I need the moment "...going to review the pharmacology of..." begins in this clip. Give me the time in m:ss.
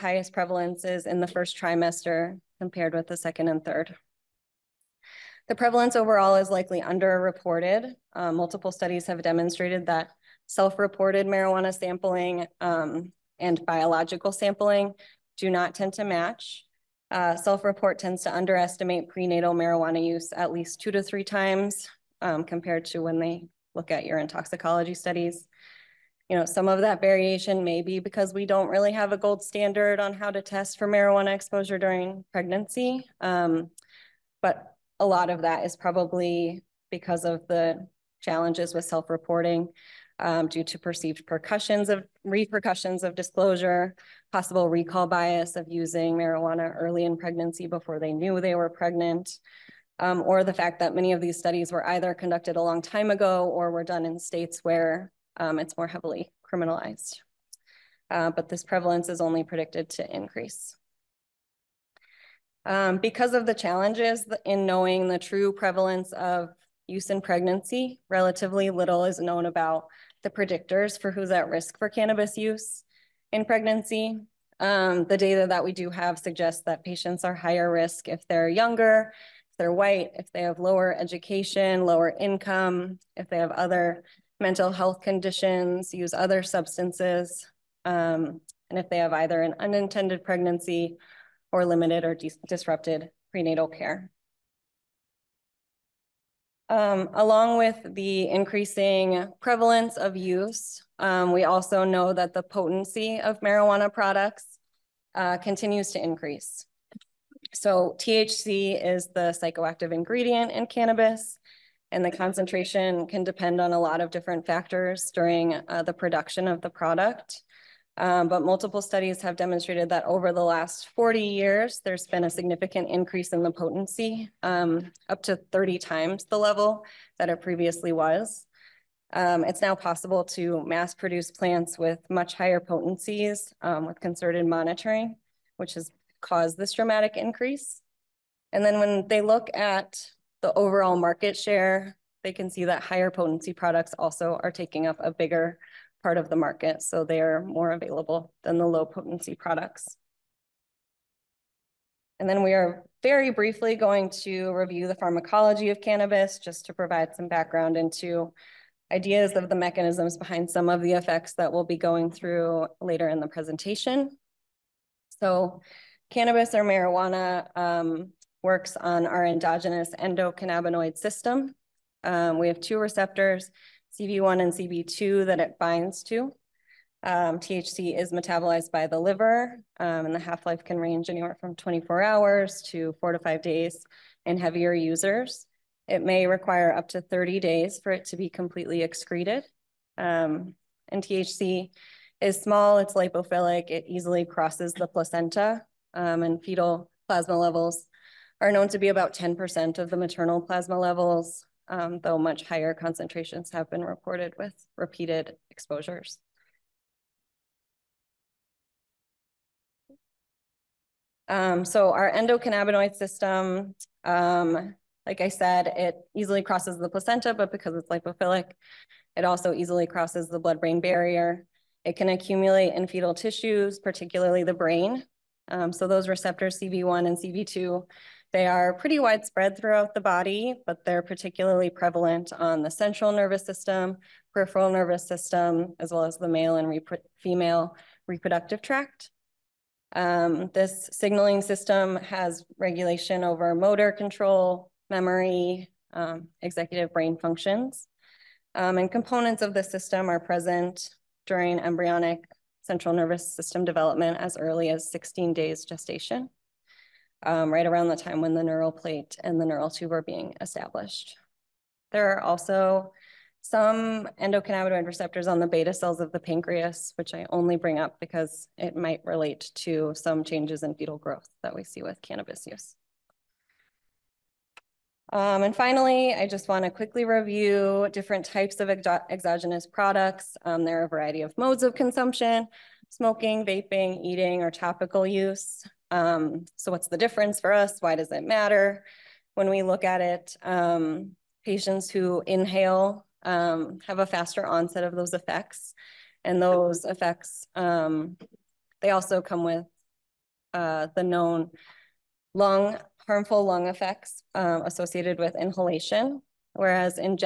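2:33.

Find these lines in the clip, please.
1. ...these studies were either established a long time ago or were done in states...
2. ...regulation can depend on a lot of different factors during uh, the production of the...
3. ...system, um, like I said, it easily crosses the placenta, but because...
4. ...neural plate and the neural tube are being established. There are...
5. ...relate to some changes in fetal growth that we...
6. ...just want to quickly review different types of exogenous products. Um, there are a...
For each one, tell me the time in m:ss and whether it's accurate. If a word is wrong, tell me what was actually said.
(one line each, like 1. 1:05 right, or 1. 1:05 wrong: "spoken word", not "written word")
1. 0:51 wrong: "conducted", not "established"
2. 1:52 wrong: "concentration", not "regulation"
3. 3:32 right
4. 4:18 right
5. 4:29 right
6. 4:36 right.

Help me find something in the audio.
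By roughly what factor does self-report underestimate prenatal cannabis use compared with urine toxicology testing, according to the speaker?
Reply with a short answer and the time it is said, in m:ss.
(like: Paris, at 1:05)
2 to 3 times, at 0:20.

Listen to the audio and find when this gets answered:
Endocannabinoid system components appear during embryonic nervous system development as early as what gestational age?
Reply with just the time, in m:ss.
4:14.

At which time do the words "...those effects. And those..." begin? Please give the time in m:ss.
4:54.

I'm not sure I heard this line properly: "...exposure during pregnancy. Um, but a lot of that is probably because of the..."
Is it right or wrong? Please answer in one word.
right.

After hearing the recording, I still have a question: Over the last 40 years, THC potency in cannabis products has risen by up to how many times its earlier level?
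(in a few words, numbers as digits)
30 times.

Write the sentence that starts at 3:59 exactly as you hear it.
Um, this signaling system has regulation over motor control, memory, um, executive brain functions.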